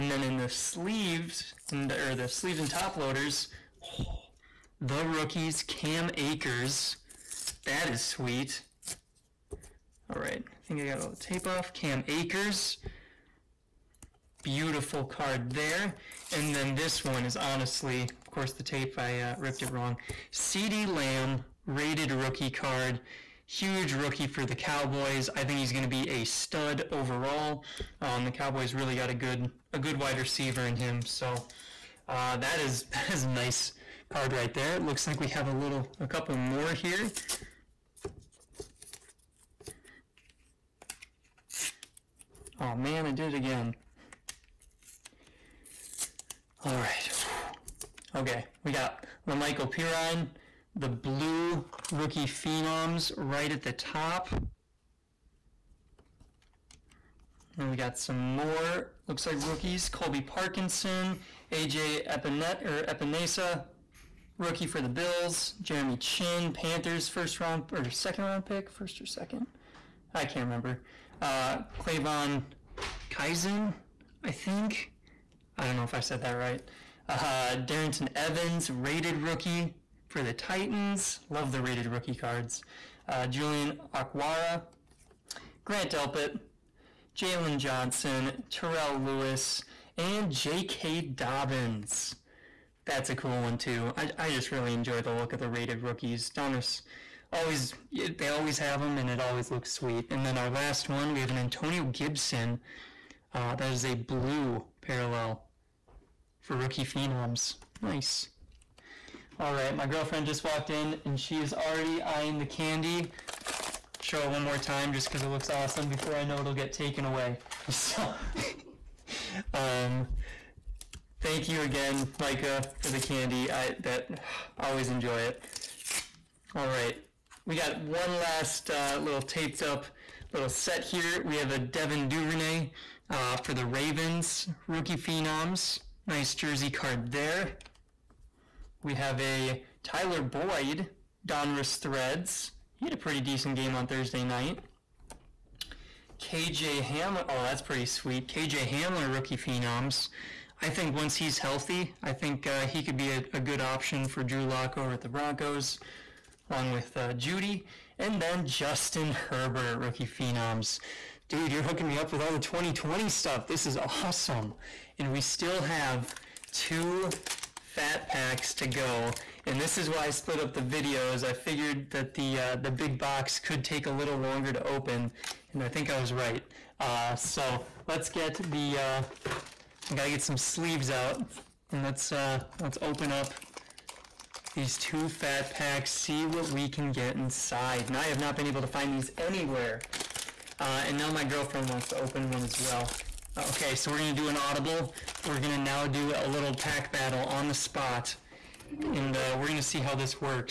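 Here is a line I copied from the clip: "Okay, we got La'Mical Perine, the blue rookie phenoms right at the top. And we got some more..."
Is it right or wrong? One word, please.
right.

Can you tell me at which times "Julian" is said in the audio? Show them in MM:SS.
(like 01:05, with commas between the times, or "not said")
01:23.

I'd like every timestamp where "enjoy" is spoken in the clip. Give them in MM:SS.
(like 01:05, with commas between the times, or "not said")
01:34, 02:04.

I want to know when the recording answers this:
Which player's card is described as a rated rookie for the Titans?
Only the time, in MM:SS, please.
01:17.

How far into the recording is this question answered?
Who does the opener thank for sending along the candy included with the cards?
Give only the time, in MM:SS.
02:02.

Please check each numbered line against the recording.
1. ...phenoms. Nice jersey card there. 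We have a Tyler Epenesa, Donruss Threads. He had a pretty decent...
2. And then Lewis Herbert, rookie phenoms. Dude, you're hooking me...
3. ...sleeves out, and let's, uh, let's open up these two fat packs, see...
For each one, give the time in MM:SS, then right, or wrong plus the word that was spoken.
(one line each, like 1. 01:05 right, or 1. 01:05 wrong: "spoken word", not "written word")
1. 02:14 wrong: "Boyd", not "Epenesa"
2. 02:37 wrong: "Justin", not "Lewis"
3. 03:00 right.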